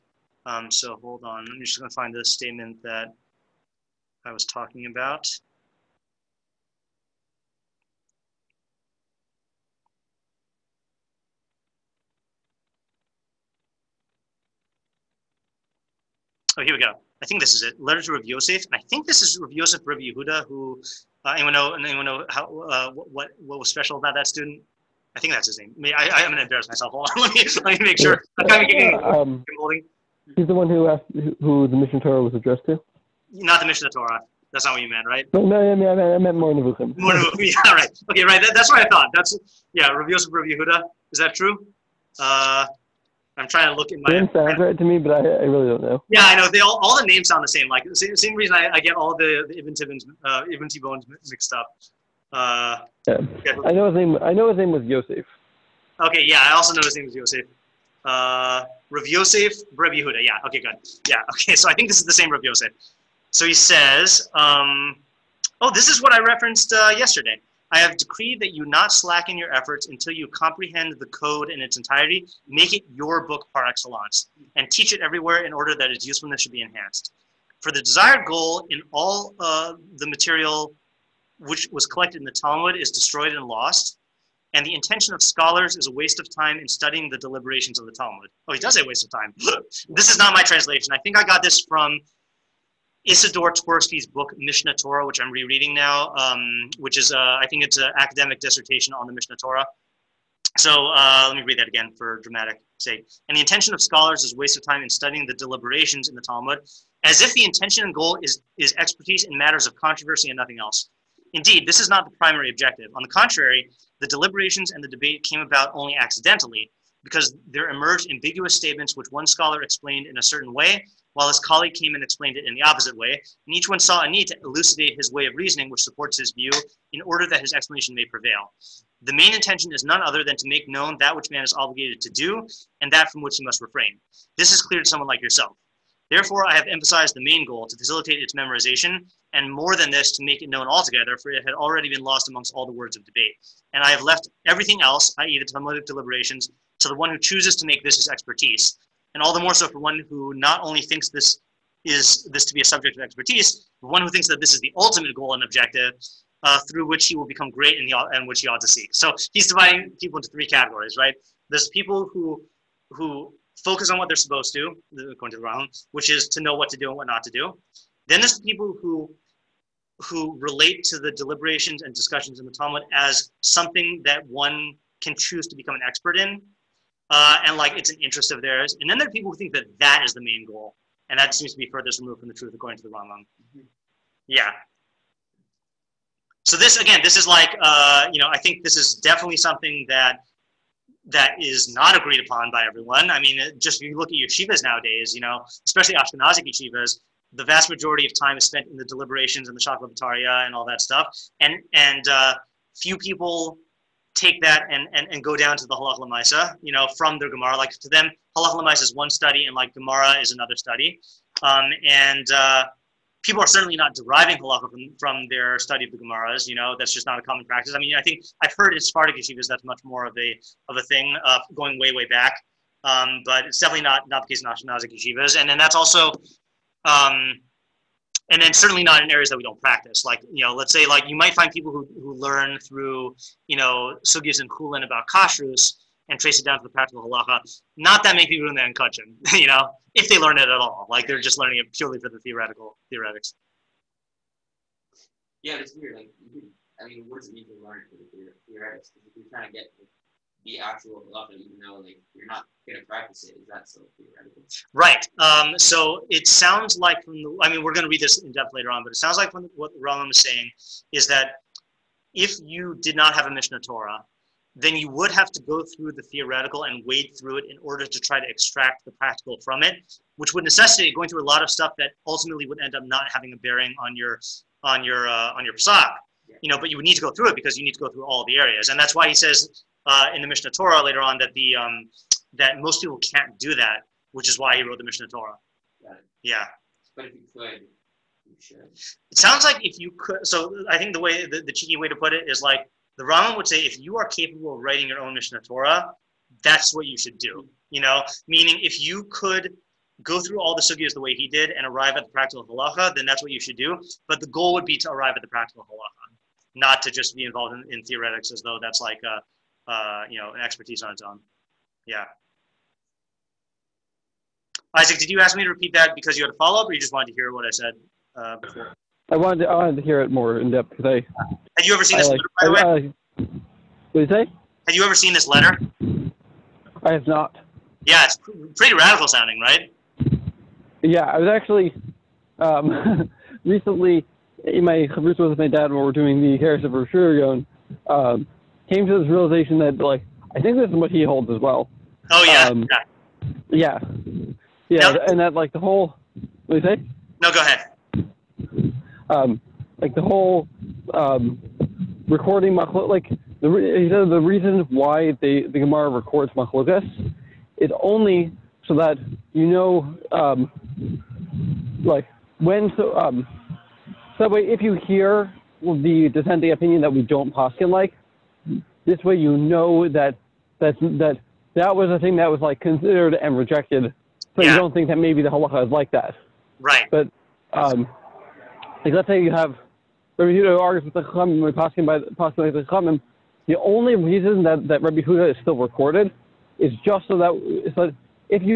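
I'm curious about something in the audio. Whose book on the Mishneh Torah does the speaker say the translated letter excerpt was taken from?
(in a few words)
Isidore Twersky.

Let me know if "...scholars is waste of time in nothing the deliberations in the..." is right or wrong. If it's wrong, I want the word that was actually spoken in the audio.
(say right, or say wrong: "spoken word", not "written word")
wrong: "studying", not "nothing".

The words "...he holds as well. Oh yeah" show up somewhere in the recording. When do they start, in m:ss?
5:40.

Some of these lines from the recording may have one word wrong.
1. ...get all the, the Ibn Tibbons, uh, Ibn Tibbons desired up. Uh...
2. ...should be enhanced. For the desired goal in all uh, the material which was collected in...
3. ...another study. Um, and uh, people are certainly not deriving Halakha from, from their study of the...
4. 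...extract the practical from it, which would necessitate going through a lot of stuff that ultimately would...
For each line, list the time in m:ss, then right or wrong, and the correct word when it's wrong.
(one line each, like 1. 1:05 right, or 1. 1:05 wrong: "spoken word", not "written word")
1. 0:48 wrong: "mixed", not "desired"
2. 1:16 right
3. 3:30 right
4. 4:28 right.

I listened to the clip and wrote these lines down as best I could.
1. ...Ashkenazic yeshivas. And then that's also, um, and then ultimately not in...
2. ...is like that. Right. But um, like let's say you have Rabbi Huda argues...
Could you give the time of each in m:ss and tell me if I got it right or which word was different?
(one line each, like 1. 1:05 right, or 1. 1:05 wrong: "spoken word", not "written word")
1. 3:44 wrong: "certainly", not "ultimately"
2. 6:15 right.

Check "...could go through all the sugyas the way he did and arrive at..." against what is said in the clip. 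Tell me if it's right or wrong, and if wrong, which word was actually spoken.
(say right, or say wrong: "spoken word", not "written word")
right.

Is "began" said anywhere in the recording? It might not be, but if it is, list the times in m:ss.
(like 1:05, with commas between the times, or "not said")
not said.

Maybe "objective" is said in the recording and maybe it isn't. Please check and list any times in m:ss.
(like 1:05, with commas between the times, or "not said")
1:52, 2:35.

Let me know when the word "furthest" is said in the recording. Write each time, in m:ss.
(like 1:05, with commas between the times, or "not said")
3:01.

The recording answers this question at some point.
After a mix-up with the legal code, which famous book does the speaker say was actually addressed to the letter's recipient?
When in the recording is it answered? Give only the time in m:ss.
0:36.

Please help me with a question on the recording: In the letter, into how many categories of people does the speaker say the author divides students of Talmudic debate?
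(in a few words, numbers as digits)
3.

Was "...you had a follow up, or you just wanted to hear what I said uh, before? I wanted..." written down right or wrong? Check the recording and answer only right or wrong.
right.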